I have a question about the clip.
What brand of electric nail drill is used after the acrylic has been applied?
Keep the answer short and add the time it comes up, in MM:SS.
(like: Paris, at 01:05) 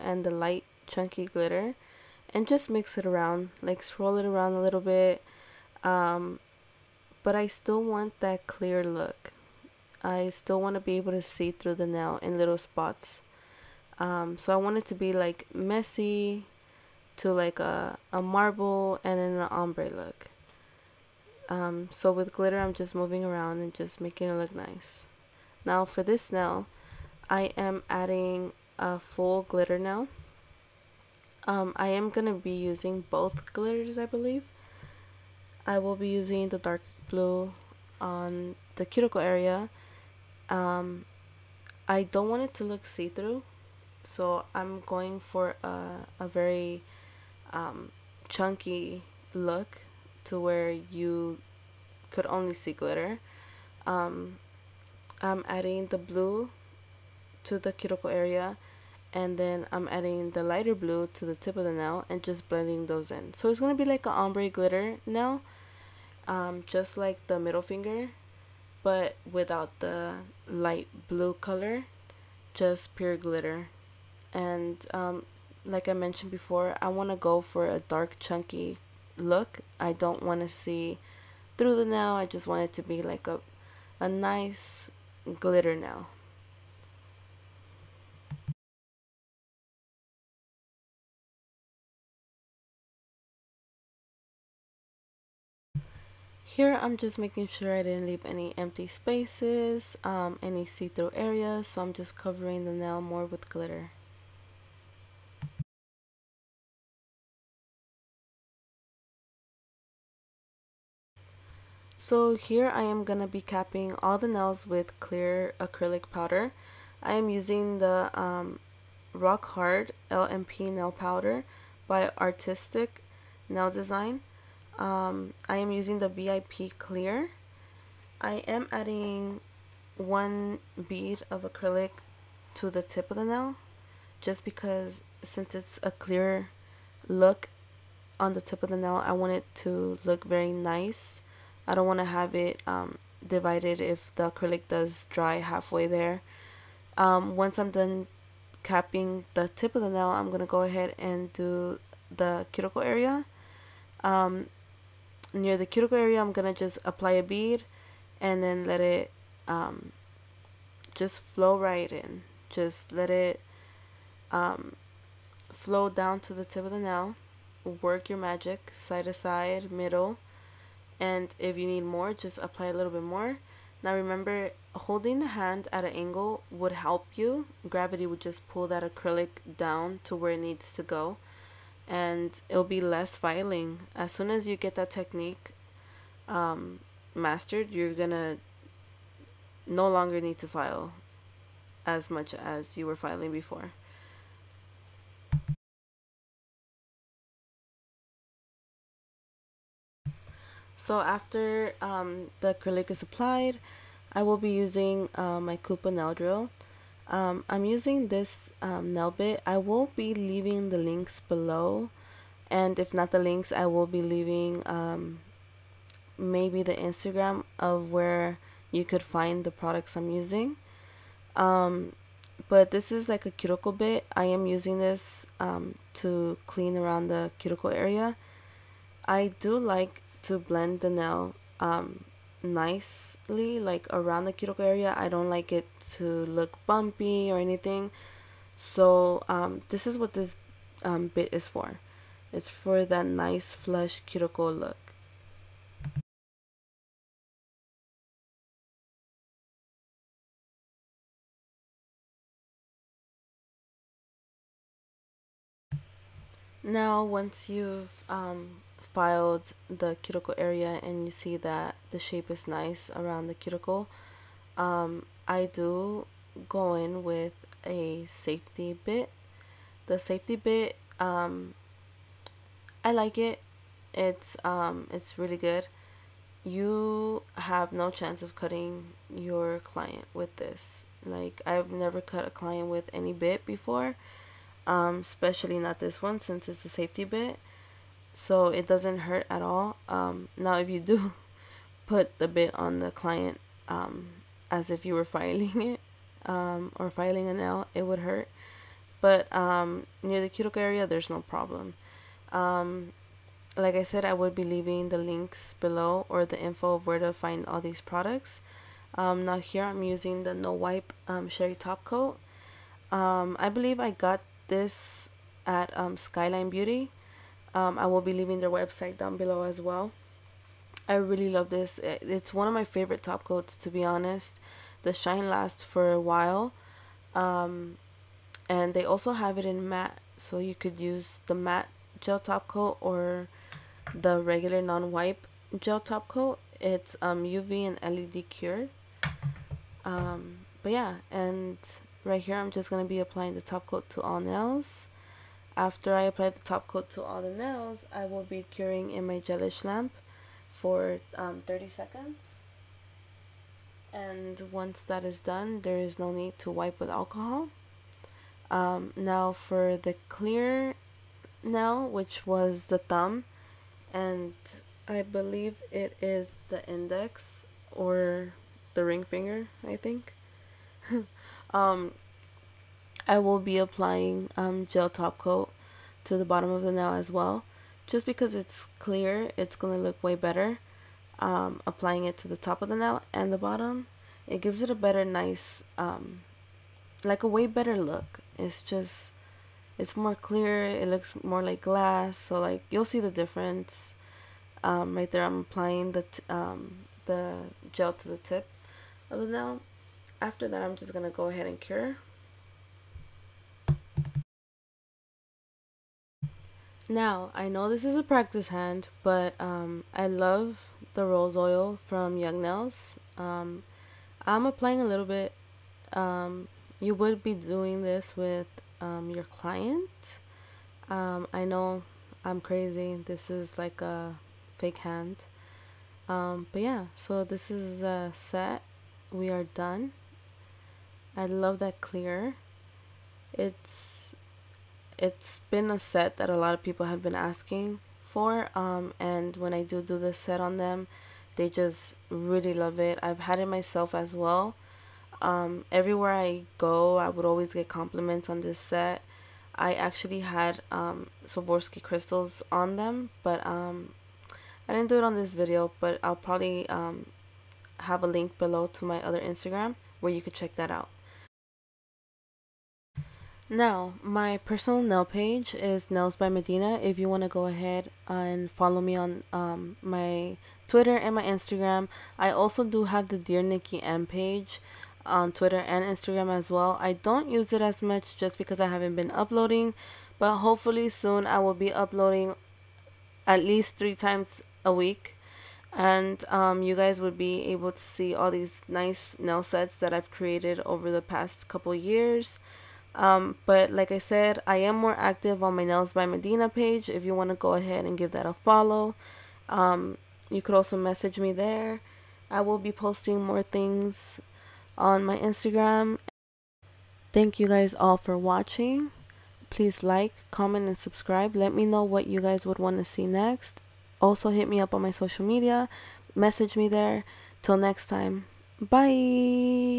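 Kupa, at 03:25.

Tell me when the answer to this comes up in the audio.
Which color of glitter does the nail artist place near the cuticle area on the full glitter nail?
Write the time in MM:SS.
00:36.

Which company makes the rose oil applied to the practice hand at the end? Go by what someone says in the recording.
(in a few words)
Young Nails.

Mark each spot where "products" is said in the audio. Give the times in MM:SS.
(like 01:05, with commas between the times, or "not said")
03:39, 05:07.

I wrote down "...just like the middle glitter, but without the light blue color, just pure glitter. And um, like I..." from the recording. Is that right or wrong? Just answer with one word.
wrong.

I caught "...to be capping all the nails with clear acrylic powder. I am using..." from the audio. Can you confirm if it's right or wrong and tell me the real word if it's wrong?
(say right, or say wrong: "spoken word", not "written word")
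right.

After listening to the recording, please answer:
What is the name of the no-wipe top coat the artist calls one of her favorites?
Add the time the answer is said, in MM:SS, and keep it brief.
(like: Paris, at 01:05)
Cheri Top Coat, at 05:11.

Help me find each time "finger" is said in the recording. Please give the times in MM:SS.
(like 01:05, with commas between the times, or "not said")
01:07, 06:09.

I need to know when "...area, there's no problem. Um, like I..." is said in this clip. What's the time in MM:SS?
05:00.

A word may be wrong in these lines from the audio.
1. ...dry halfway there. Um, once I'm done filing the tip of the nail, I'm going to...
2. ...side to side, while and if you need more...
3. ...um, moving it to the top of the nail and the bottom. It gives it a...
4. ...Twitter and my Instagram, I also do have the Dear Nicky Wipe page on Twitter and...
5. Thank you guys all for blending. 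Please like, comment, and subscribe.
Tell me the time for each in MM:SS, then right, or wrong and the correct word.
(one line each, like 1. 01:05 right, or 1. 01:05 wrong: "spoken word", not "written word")
1. 02:25 wrong: "capping", not "filing"
2. 02:48 wrong: "middle", not "while"
3. 06:21 wrong: "applying", not "moving"
4. 07:50 wrong: "Emm", not "Wipe"
5. 08:27 wrong: "watching", not "blending".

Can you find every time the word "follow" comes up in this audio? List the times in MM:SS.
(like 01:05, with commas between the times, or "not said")
07:48, 08:18.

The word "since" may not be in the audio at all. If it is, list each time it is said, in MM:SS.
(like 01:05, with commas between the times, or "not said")
02:15, 04:46.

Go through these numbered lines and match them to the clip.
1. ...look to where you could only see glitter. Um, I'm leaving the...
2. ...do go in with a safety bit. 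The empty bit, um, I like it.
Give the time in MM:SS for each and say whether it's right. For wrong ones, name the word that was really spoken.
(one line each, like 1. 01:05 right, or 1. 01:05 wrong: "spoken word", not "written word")
1. 00:49 wrong: "adding", not "leaving"
2. 04:25 wrong: "safety", not "empty".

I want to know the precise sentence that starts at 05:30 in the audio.
So you could use the matte gel top coat or the regular non-wipe gel top coat.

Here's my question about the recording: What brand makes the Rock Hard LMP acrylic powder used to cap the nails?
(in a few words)
Artistic Nail Design.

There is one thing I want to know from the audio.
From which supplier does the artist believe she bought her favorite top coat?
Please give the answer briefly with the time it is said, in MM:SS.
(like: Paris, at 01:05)
Skyline Beauty, at 05:15.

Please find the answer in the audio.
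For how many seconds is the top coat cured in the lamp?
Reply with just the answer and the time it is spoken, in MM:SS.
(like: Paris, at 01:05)
30 seconds, at 05:51.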